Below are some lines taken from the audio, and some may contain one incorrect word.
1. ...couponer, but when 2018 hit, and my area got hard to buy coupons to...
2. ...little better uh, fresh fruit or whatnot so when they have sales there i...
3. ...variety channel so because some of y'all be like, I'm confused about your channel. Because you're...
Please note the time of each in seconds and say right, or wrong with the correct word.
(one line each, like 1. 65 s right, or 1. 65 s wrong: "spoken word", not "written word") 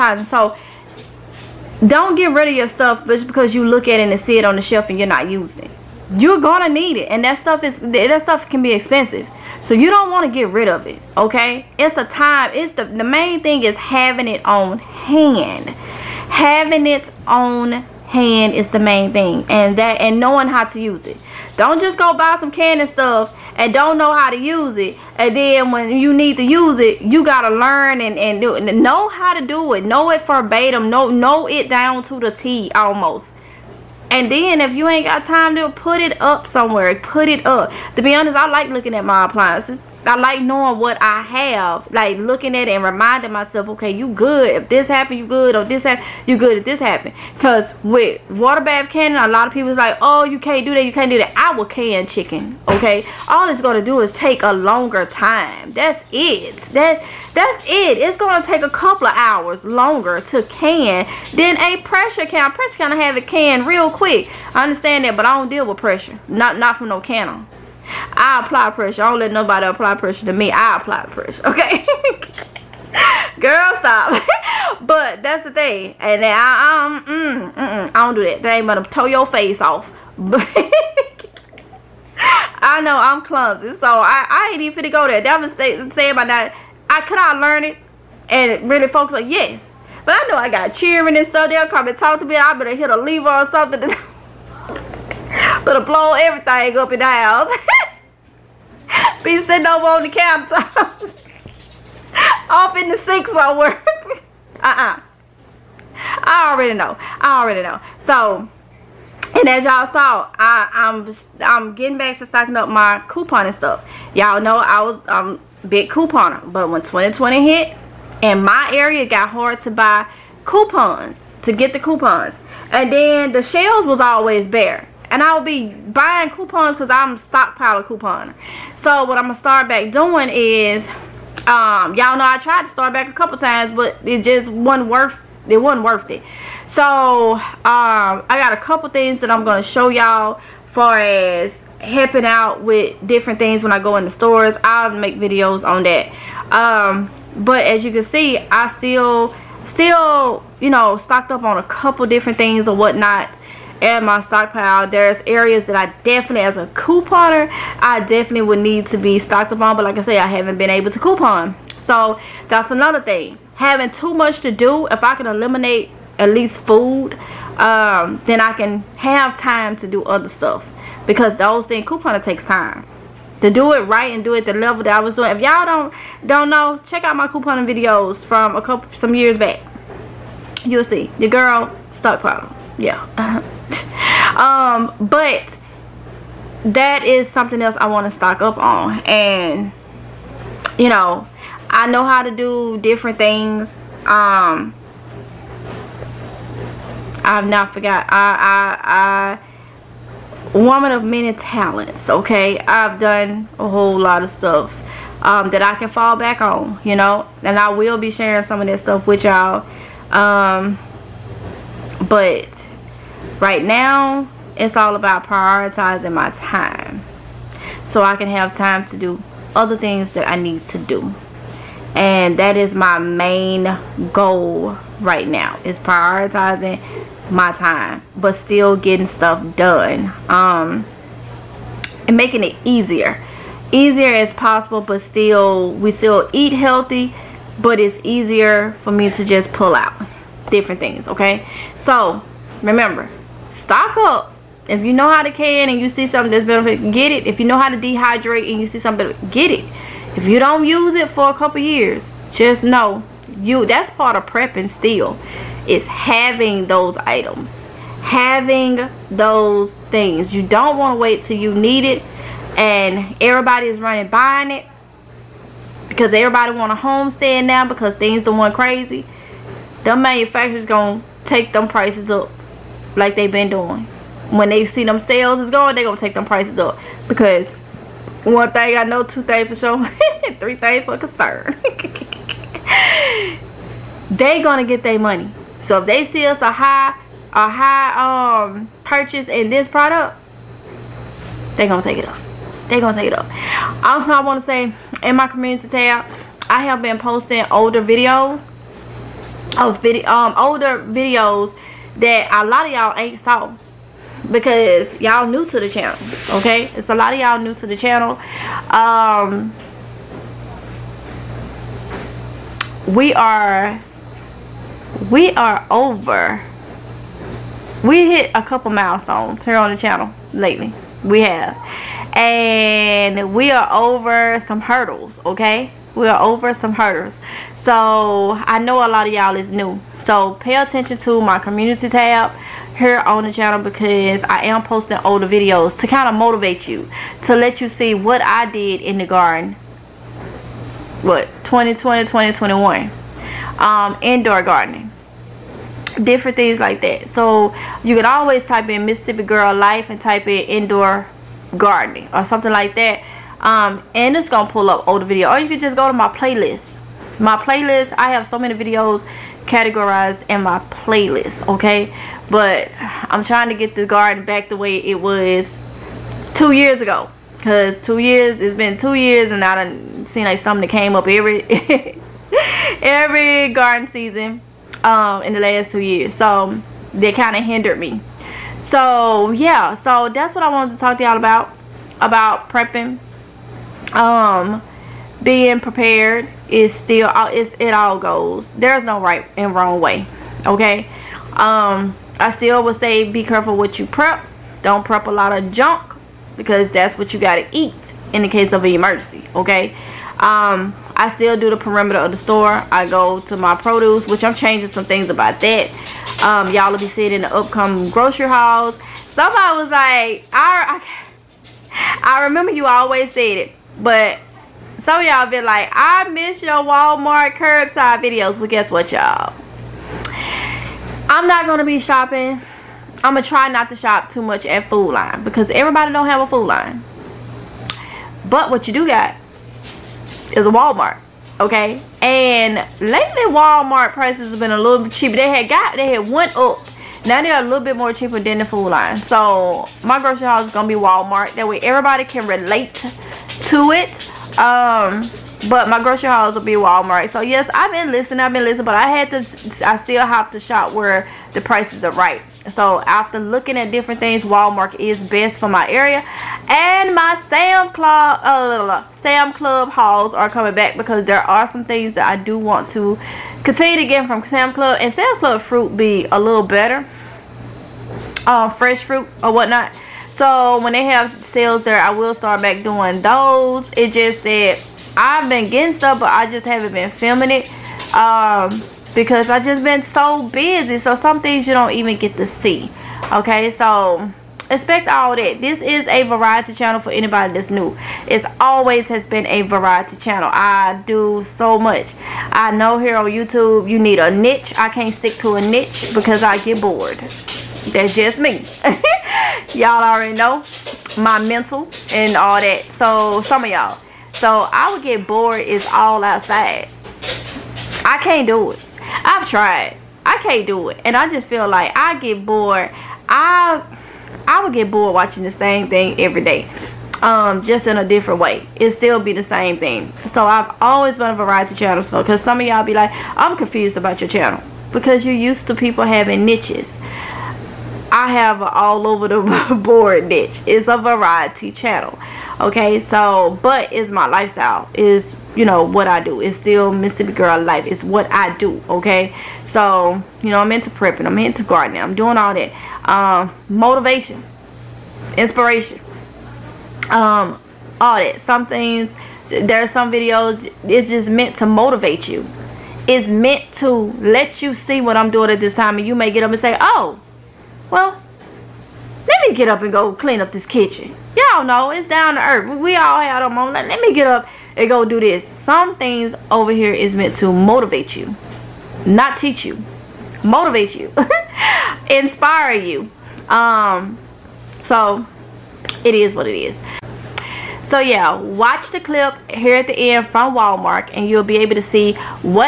1. 115 s wrong: "2020", not "2018"
2. 466 s right
3. 521 s right.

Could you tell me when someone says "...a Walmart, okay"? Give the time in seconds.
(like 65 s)
430 s.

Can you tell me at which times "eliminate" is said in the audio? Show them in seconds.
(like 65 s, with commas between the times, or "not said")
165 s.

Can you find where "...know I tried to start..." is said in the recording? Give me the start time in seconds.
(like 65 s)
132 s.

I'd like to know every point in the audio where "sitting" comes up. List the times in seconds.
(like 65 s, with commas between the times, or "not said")
99 s.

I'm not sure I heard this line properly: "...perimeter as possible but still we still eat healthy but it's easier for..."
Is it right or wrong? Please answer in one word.
wrong.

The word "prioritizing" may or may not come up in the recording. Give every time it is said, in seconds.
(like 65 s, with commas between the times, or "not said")
215 s, 225 s.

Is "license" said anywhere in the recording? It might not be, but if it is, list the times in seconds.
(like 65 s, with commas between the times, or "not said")
not said.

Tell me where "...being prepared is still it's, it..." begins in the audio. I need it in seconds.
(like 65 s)
385 s.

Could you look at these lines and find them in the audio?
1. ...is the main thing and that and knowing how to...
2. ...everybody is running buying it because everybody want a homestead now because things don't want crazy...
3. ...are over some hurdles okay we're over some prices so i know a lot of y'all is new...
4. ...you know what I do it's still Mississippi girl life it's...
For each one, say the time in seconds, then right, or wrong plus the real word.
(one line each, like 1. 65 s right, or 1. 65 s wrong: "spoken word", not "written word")
1. 18 s right
2. 263 s right
3. 323 s wrong: "hurdles", not "prices"
4. 535 s right.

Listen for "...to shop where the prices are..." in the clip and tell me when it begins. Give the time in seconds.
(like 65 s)
450 s.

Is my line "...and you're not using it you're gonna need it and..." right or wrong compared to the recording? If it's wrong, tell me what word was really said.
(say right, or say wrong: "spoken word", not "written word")
right.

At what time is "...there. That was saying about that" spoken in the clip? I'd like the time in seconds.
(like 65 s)
85 s.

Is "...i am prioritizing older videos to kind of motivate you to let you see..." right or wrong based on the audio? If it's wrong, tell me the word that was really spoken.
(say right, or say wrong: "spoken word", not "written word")
wrong: "posting", not "prioritizing".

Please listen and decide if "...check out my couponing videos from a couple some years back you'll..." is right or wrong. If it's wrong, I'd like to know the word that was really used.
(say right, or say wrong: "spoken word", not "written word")
right.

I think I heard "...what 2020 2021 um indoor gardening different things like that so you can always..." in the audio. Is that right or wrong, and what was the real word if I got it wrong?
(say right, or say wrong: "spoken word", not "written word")
right.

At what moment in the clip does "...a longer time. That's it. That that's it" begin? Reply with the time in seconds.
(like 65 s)
54 s.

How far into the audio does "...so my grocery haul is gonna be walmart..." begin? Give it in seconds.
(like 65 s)
439 s.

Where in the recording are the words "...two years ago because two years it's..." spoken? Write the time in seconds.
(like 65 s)
366 s.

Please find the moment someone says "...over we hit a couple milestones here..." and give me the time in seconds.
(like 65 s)
315 s.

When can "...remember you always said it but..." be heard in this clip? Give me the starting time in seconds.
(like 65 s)
412 s.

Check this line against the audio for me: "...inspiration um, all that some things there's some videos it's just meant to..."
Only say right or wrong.
right.